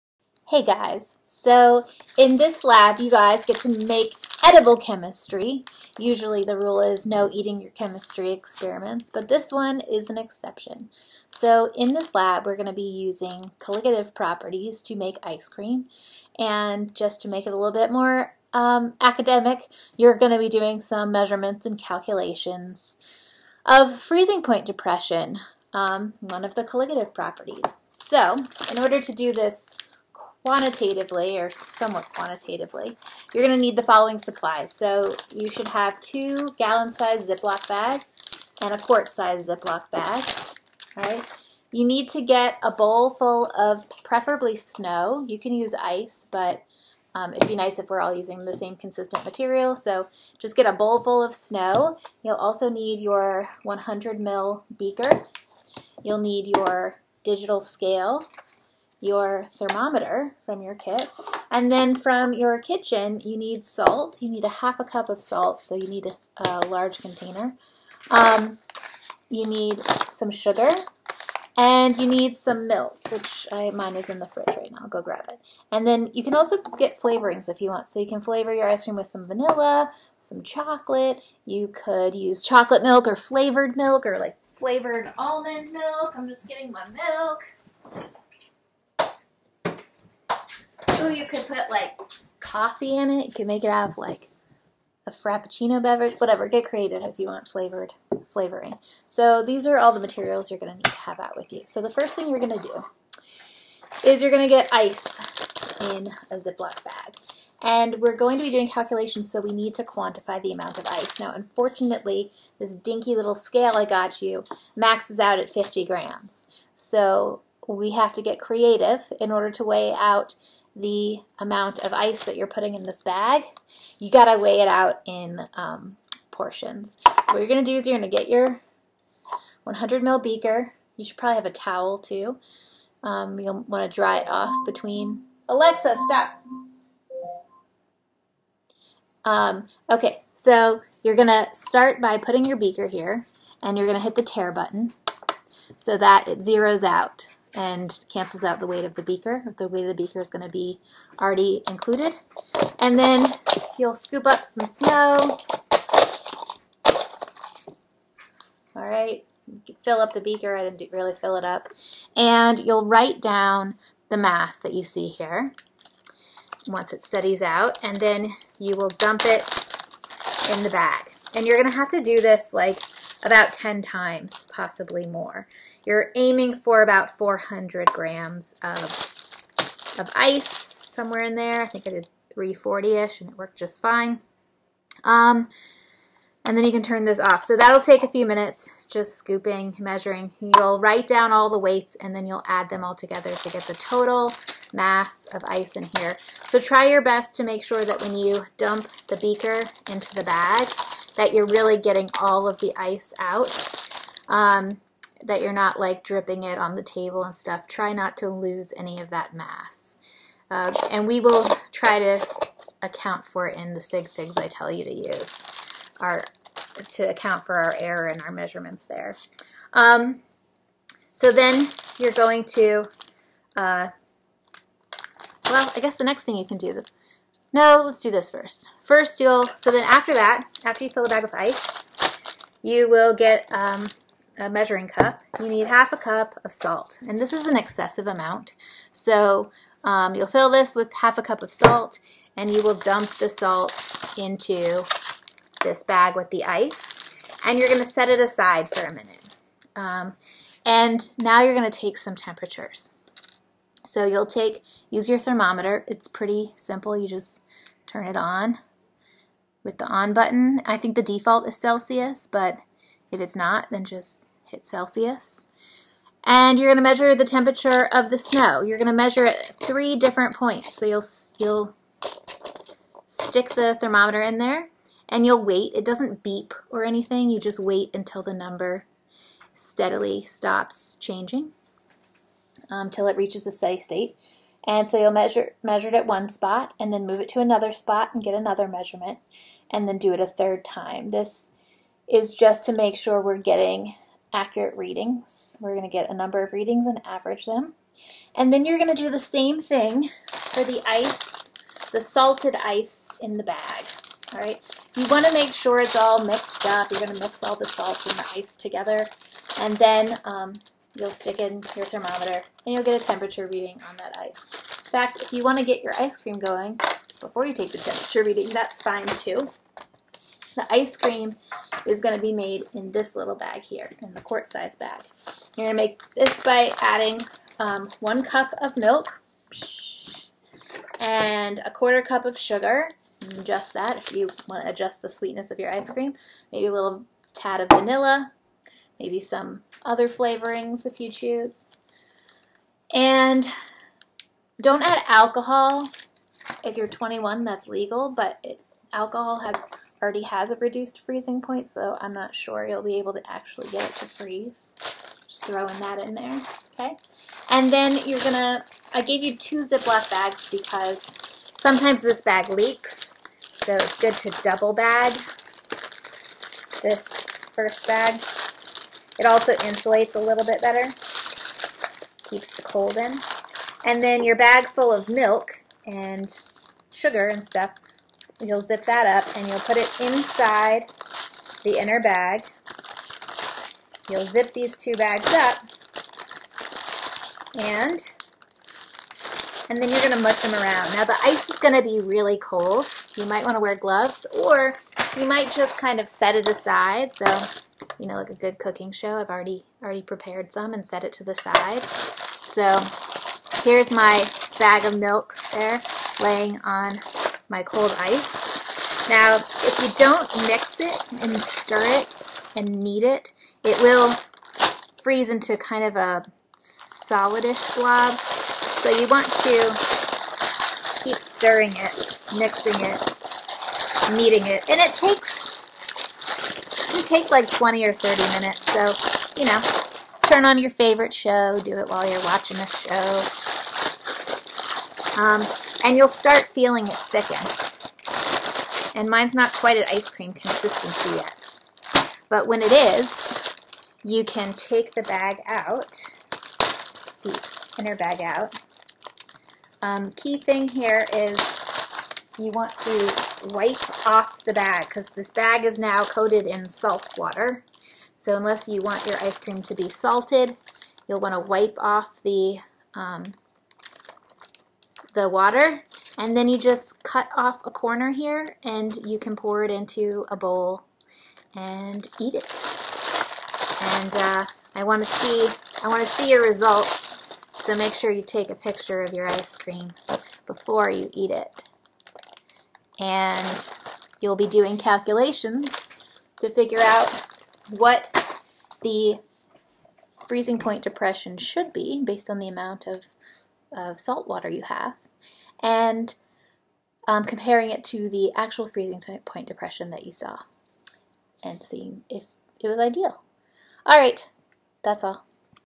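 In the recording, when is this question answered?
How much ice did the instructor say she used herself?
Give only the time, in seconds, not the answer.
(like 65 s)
182 s.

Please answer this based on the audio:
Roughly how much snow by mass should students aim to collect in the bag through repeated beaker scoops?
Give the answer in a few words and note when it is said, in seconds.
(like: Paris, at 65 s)
400 grams, at 177 s.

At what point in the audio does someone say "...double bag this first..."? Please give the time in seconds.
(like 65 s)
364 s.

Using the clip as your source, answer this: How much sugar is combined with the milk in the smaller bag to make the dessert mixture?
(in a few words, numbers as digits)
A quarter cup.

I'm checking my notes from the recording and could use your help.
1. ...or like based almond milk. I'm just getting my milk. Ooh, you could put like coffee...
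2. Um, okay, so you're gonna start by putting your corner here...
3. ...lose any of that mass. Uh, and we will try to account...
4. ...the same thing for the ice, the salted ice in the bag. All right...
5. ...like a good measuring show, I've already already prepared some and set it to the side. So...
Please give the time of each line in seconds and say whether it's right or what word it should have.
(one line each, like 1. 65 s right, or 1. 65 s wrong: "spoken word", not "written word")
1. 84 s wrong: "flavored", not "based"
2. 139 s wrong: "beaker", not "corner"
3. 208 s right
4. 299 s right
5. 398 s wrong: "cooking", not "measuring".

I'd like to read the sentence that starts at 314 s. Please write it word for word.
In fact, if you want to get your ice cream going before you take the temperature reading, that's fine too.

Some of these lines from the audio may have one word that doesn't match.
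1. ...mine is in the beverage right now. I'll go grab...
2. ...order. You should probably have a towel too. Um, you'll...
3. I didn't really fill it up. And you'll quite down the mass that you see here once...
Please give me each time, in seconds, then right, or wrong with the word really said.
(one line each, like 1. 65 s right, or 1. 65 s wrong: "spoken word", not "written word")
1. 73 s wrong: "fridge", not "beverage"
2. 130 s wrong: "beaker", not "order"
3. 160 s wrong: "write", not "quite".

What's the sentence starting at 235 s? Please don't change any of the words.
You need half a cup of salt, and this is an excessive amount.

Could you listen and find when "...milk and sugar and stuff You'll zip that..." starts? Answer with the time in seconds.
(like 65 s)
375 s.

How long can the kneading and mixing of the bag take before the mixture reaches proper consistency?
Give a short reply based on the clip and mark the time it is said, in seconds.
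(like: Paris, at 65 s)
20 or 30 minutes, at 427 s.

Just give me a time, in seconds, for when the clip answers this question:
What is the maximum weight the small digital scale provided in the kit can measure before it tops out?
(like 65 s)
115 s.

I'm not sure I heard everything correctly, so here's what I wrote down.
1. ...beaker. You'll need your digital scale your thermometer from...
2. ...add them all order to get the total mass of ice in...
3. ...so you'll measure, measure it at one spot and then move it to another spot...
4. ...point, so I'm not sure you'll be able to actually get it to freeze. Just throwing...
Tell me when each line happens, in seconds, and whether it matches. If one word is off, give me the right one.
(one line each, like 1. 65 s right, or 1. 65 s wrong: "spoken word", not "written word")
1. 54 s right
2. 192 s wrong: "together", not "order"
3. 284 s right
4. 351 s right.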